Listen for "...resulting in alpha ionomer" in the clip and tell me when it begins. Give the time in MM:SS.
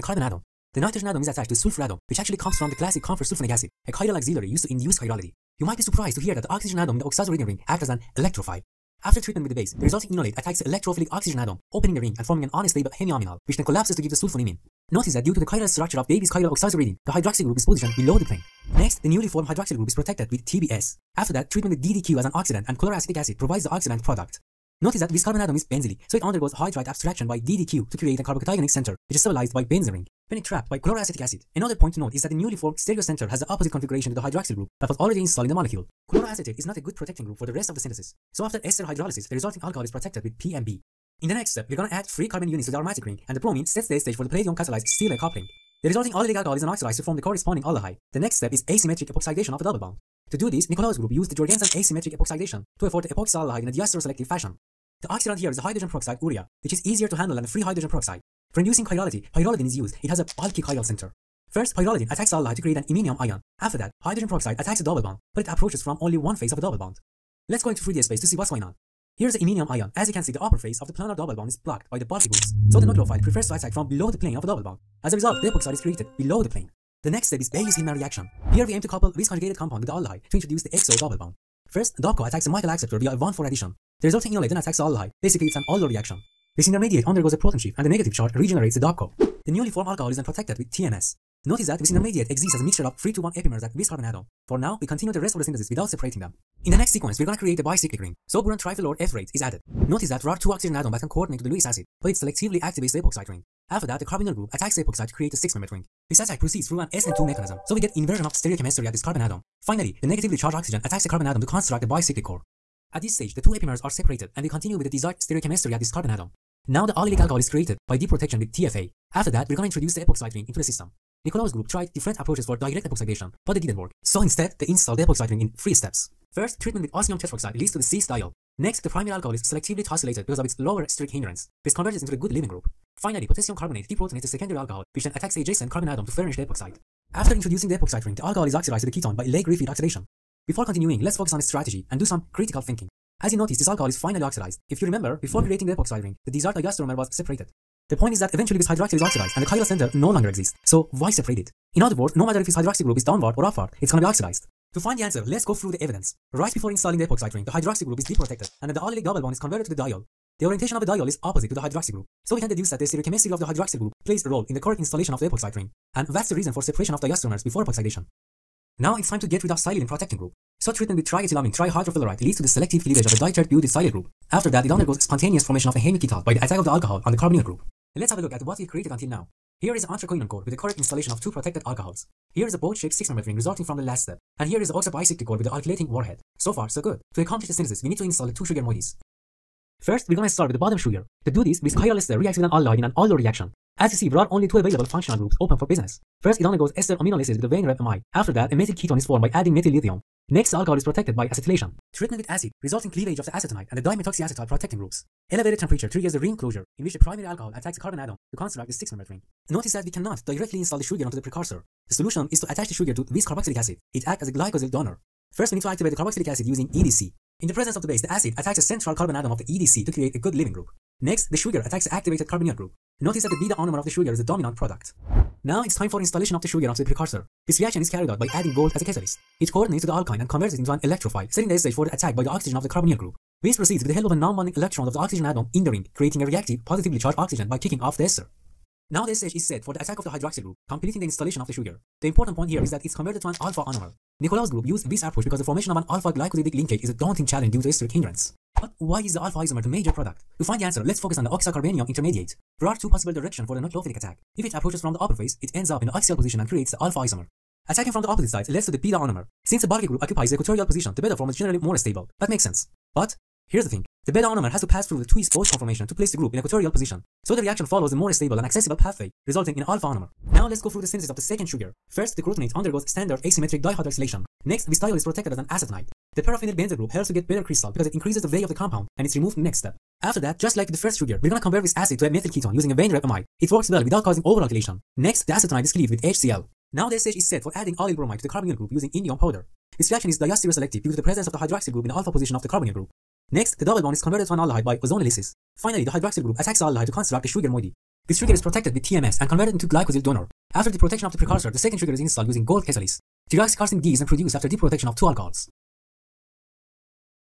04:29.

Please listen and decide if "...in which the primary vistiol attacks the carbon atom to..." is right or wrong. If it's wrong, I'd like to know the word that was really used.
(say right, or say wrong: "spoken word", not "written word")
wrong: "alcohol", not "vistiol".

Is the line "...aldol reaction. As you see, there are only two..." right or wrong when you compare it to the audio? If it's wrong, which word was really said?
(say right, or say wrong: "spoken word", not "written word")
right.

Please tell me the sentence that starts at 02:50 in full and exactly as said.
So treatment with triethylamine trihydrofluoride leads to the selective cleavage of a diterate butyl silyl group.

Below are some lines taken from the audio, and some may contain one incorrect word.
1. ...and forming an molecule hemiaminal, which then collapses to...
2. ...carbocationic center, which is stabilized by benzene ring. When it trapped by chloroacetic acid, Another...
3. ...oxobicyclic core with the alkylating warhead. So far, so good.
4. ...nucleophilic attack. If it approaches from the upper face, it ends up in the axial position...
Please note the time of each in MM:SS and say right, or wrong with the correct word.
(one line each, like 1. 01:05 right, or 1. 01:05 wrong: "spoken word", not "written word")
1. 00:12 wrong: "unstable", not "molecule"
2. 00:28 right
3. 03:04 right
4. 04:13 right.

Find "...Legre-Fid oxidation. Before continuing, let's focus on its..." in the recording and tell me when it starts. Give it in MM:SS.
02:19.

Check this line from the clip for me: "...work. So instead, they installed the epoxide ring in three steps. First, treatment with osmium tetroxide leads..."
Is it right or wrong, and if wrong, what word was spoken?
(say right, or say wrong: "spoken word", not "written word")
right.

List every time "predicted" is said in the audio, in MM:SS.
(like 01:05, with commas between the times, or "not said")
not said.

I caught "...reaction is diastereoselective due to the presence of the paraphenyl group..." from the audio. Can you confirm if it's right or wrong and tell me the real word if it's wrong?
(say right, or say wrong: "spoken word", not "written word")
wrong: "hydroxyl", not "paraphenyl".